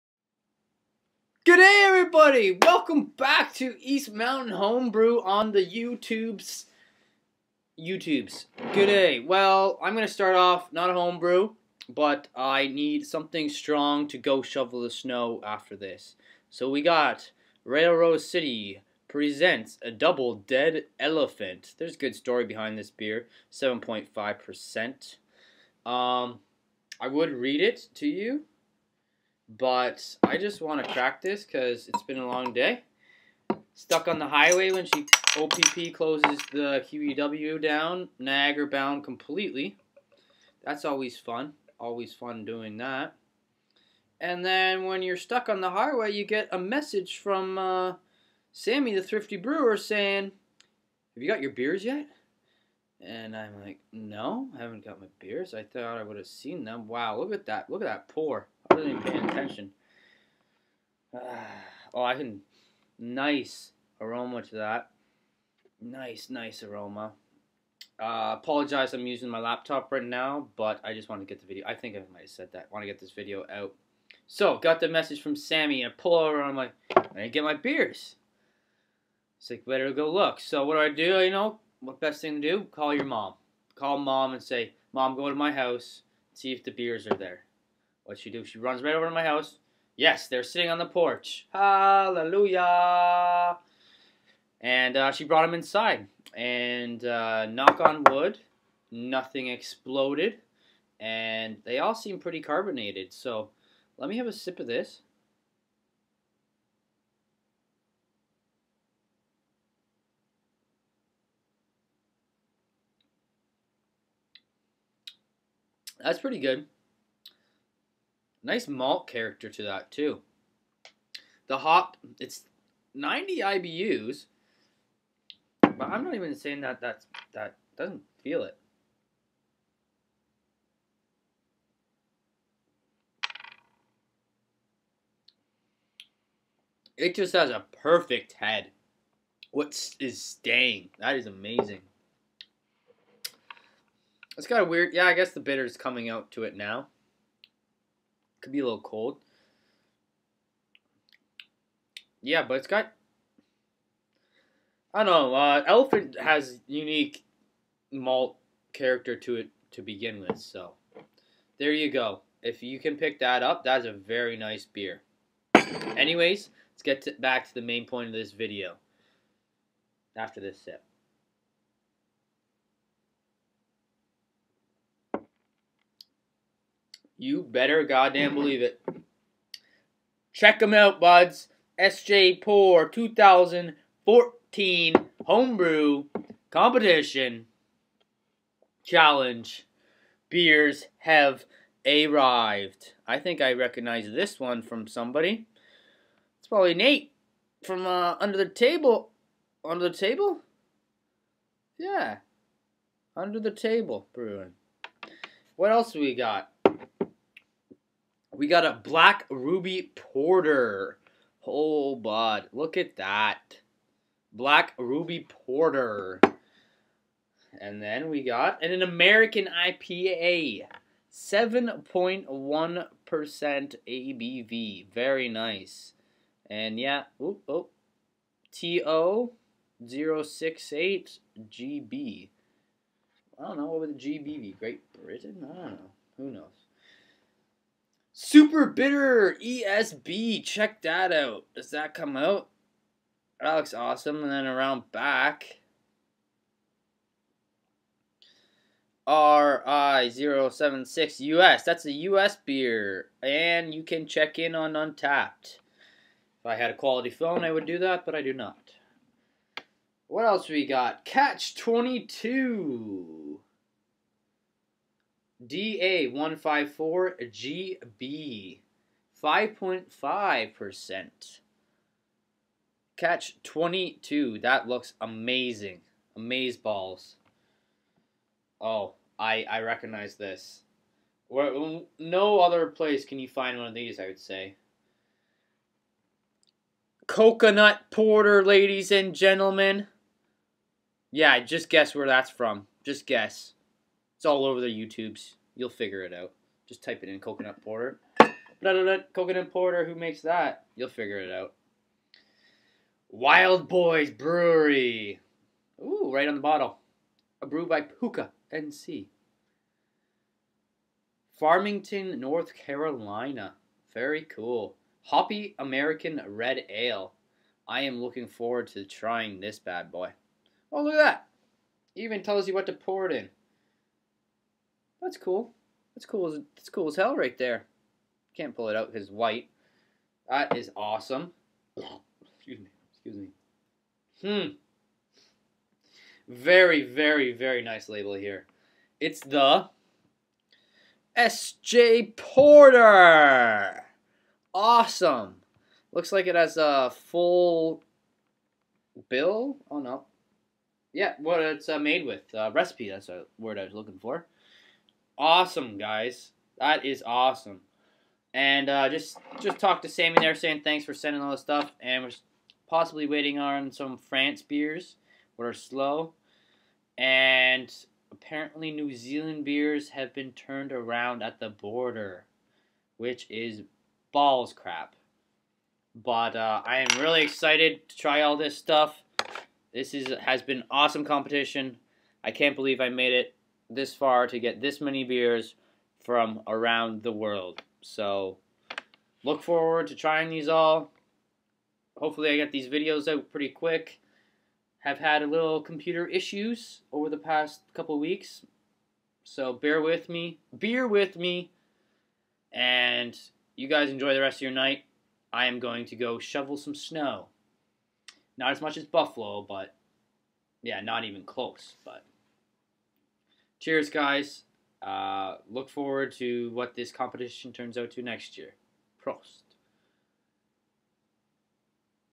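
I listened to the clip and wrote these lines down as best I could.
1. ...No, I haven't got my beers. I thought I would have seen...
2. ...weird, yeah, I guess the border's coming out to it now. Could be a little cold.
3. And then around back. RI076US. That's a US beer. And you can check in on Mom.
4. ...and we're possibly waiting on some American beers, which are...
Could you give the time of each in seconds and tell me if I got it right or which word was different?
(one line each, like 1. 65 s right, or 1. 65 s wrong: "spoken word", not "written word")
1. 53 s right
2. 144 s wrong: "bitter", not "border"
3. 244 s wrong: "Untappd", not "Mom"
4. 361 s wrong: "France", not "American".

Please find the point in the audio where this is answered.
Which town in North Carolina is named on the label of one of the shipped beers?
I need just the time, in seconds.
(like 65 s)
311 s.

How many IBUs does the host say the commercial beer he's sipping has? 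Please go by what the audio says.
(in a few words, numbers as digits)
90.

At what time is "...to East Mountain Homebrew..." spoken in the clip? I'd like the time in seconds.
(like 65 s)
3 s.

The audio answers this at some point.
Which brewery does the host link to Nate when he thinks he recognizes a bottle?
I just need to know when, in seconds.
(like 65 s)
203 s.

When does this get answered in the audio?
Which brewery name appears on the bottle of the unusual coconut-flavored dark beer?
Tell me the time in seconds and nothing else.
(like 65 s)
303 s.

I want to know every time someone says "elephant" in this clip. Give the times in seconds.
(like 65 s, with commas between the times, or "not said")
21 s, 155 s.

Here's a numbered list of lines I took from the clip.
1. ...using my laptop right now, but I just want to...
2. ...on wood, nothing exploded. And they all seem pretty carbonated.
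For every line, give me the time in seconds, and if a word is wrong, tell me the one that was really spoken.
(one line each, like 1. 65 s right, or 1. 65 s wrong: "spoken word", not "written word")
1. 69 s right
2. 97 s right.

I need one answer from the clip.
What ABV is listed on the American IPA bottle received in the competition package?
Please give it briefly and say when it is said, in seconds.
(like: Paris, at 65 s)
7.1%, at 221 s.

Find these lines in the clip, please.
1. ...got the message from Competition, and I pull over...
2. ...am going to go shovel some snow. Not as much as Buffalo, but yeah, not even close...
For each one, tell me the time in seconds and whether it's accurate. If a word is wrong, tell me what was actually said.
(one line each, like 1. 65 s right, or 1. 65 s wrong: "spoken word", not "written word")
1. 74 s wrong: "Sammy", not "Competition"
2. 405 s right.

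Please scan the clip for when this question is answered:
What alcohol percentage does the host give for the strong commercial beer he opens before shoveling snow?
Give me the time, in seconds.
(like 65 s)
23 s.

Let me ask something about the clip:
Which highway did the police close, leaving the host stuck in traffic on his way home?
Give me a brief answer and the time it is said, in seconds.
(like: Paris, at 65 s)
QEW, at 36 s.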